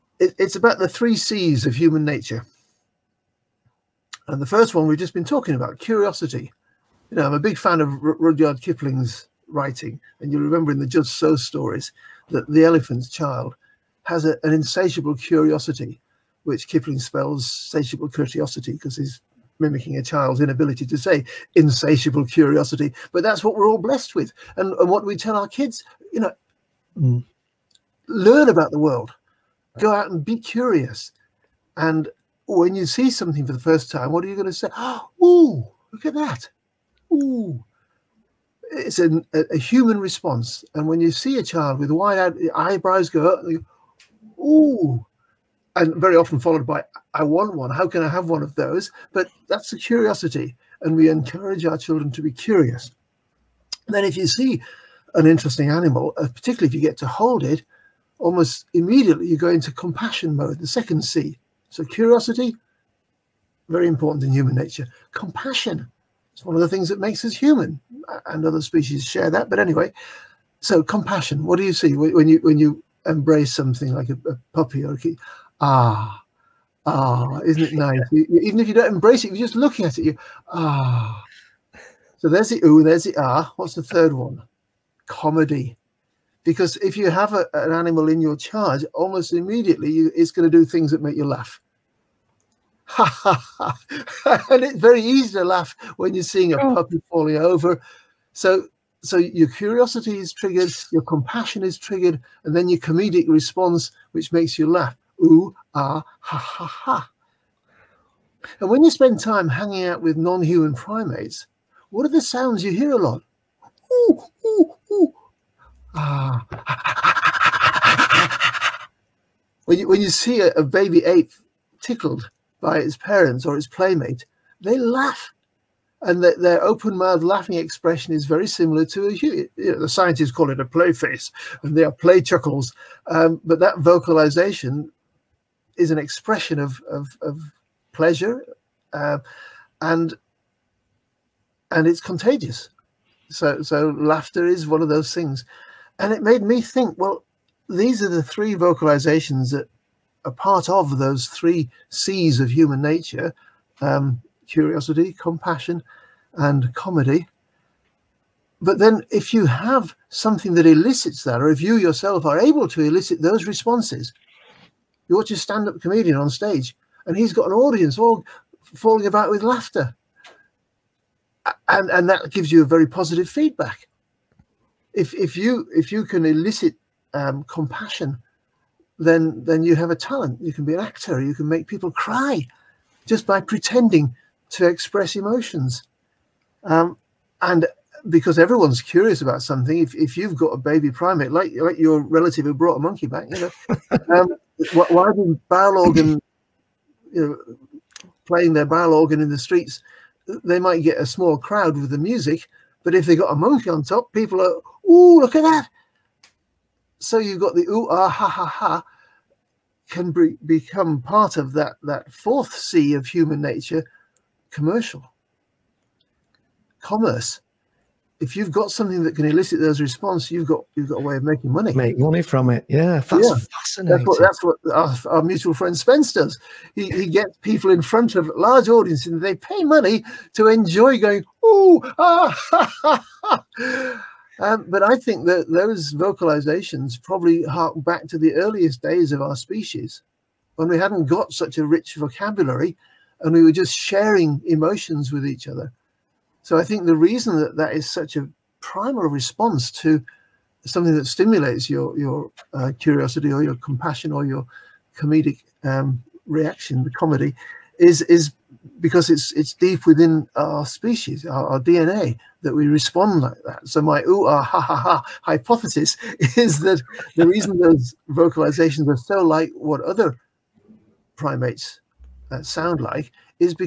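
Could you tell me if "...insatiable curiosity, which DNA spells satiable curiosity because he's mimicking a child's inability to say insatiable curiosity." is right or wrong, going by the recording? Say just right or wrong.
wrong.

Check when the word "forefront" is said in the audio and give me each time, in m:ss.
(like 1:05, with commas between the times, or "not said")
not said.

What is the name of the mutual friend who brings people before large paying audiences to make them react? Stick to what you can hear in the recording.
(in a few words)
Spence.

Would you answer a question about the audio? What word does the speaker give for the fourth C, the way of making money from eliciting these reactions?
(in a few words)
commerce.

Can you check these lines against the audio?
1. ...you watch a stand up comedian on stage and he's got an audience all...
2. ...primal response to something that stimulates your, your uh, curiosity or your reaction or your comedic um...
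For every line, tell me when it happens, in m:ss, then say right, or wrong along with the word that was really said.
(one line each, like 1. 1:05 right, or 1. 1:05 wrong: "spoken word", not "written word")
1. 2:45 right
2. 4:08 wrong: "compassion", not "reaction".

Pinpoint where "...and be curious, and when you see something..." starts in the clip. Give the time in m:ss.
0:30.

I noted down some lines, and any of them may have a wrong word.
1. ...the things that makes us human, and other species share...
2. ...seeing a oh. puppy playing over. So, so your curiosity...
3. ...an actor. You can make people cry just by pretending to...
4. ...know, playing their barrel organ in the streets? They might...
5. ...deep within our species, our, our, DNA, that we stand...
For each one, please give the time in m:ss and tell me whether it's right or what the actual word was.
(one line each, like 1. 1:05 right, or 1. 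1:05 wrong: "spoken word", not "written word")
1. 1:06 right
2. 1:36 wrong: "falling", not "playing"
3. 3:00 right
4. 3:17 right
5. 4:19 wrong: "respond", not "stand".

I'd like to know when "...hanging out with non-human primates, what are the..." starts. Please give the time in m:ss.
1:49.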